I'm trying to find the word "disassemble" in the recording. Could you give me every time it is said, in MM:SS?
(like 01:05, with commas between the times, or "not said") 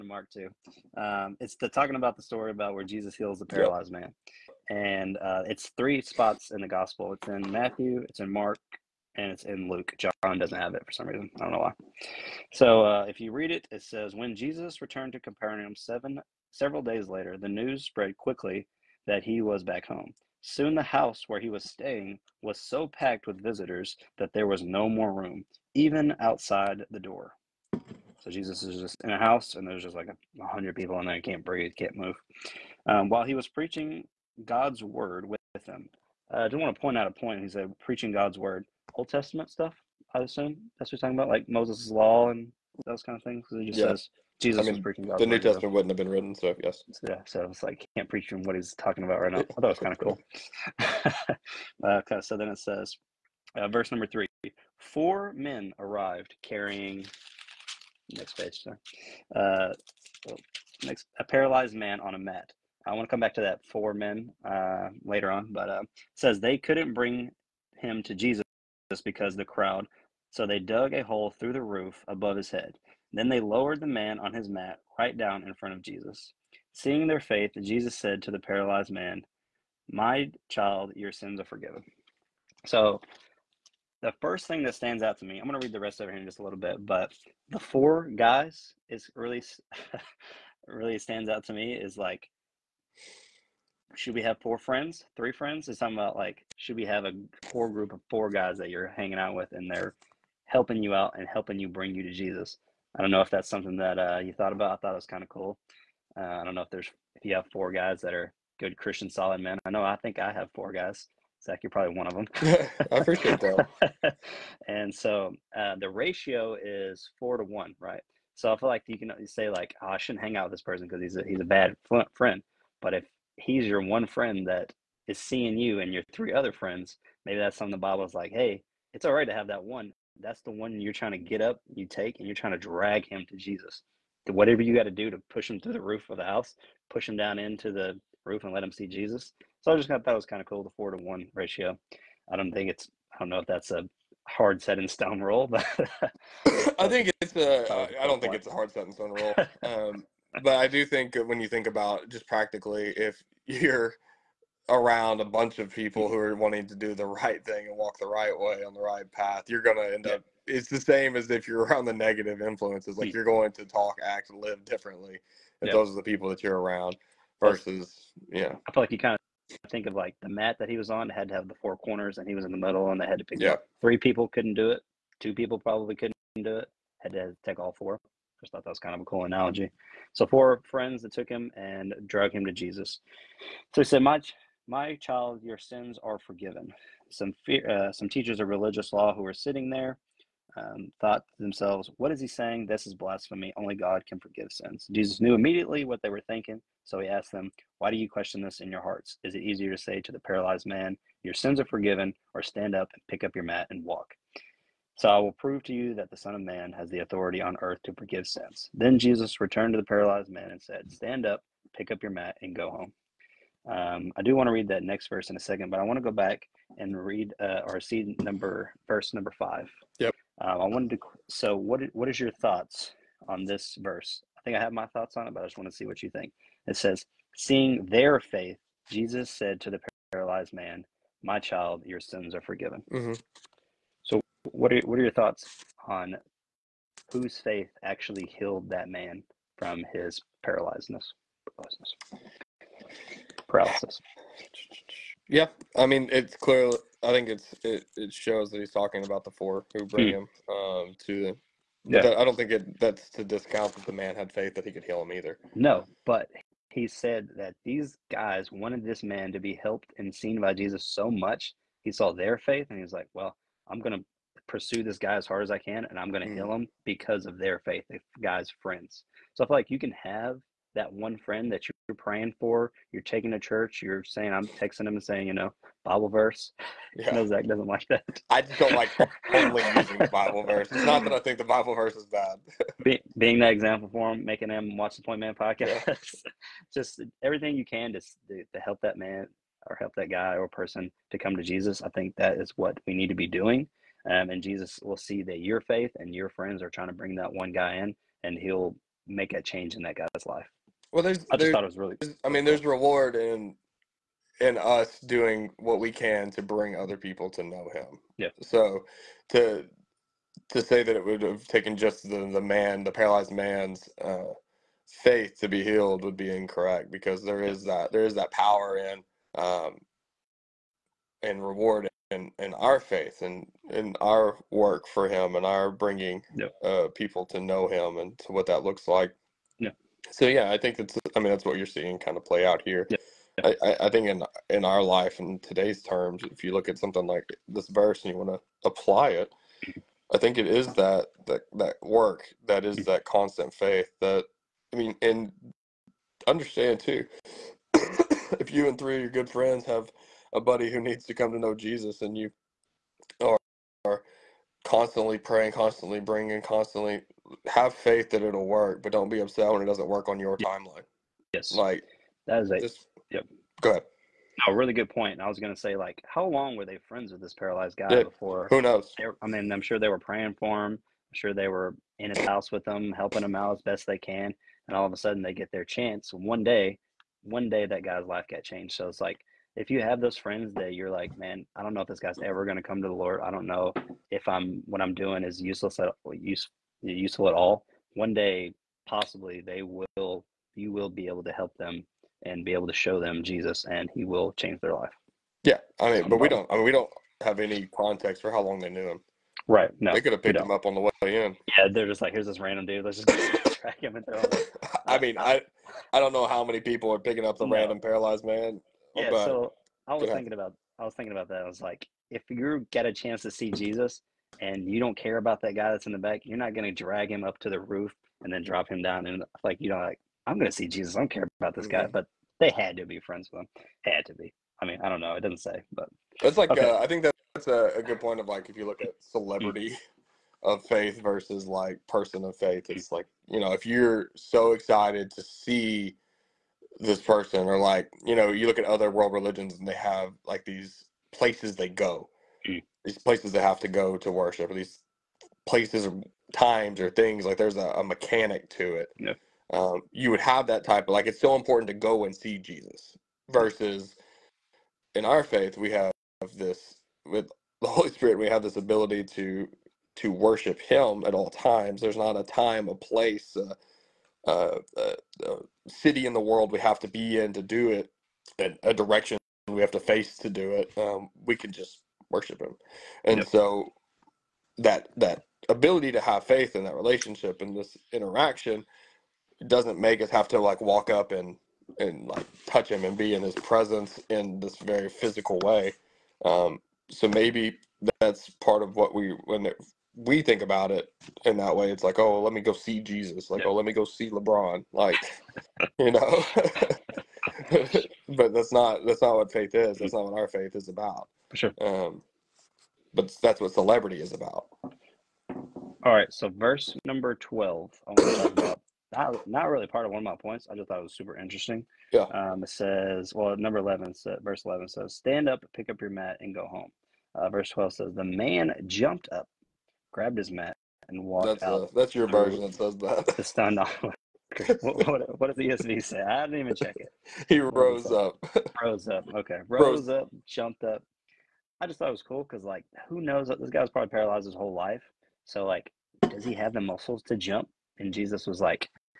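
not said.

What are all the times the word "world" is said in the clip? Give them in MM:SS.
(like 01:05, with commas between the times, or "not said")
07:18, 07:46.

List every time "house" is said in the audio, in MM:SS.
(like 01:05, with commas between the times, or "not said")
00:20, 00:29, 02:16, 06:12.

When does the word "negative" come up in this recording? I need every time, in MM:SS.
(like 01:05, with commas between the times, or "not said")
02:41.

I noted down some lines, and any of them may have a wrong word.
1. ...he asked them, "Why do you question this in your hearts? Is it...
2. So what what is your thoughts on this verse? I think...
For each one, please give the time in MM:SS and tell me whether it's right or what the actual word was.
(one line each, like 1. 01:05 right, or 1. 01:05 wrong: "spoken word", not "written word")
1. 03:16 right
2. 03:41 right.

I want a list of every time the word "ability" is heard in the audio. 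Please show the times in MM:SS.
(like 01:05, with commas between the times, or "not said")
07:38, 07:55.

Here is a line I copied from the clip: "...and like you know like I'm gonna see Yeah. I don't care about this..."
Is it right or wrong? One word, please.
wrong.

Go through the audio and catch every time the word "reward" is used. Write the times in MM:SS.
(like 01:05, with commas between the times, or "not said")
05:02, 05:21.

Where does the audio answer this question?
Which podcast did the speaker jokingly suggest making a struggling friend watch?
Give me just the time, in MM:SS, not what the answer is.
04:45.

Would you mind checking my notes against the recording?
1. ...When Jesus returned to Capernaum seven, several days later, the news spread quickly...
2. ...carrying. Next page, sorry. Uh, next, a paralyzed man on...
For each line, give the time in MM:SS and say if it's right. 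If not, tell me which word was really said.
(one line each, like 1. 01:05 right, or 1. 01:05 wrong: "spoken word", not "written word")
1. 00:14 right
2. 00:56 right.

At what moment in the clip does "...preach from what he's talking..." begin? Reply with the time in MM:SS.
00:48.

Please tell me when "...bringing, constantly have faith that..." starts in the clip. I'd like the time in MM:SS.
05:55.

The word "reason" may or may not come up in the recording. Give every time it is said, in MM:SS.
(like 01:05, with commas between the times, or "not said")
00:11.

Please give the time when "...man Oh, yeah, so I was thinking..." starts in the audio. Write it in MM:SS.
06:48.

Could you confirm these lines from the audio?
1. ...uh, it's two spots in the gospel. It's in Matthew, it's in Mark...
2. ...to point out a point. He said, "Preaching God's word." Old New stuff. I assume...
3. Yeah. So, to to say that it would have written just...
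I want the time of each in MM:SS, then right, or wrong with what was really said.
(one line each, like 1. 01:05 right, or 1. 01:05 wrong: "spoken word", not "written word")
1. 00:05 wrong: "three", not "two"
2. 00:36 wrong: "Testament", not "New"
3. 05:08 wrong: "taken", not "written".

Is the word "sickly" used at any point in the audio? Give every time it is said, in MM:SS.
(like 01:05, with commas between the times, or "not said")
not said.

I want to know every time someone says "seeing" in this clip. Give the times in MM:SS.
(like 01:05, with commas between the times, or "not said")
01:16, 02:05, 03:47, 05:31.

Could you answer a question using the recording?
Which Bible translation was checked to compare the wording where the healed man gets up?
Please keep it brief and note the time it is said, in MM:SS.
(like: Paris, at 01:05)
ESV, at 08:45.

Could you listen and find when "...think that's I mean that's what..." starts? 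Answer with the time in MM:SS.
05:30.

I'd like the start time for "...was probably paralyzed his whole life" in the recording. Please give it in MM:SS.
08:53.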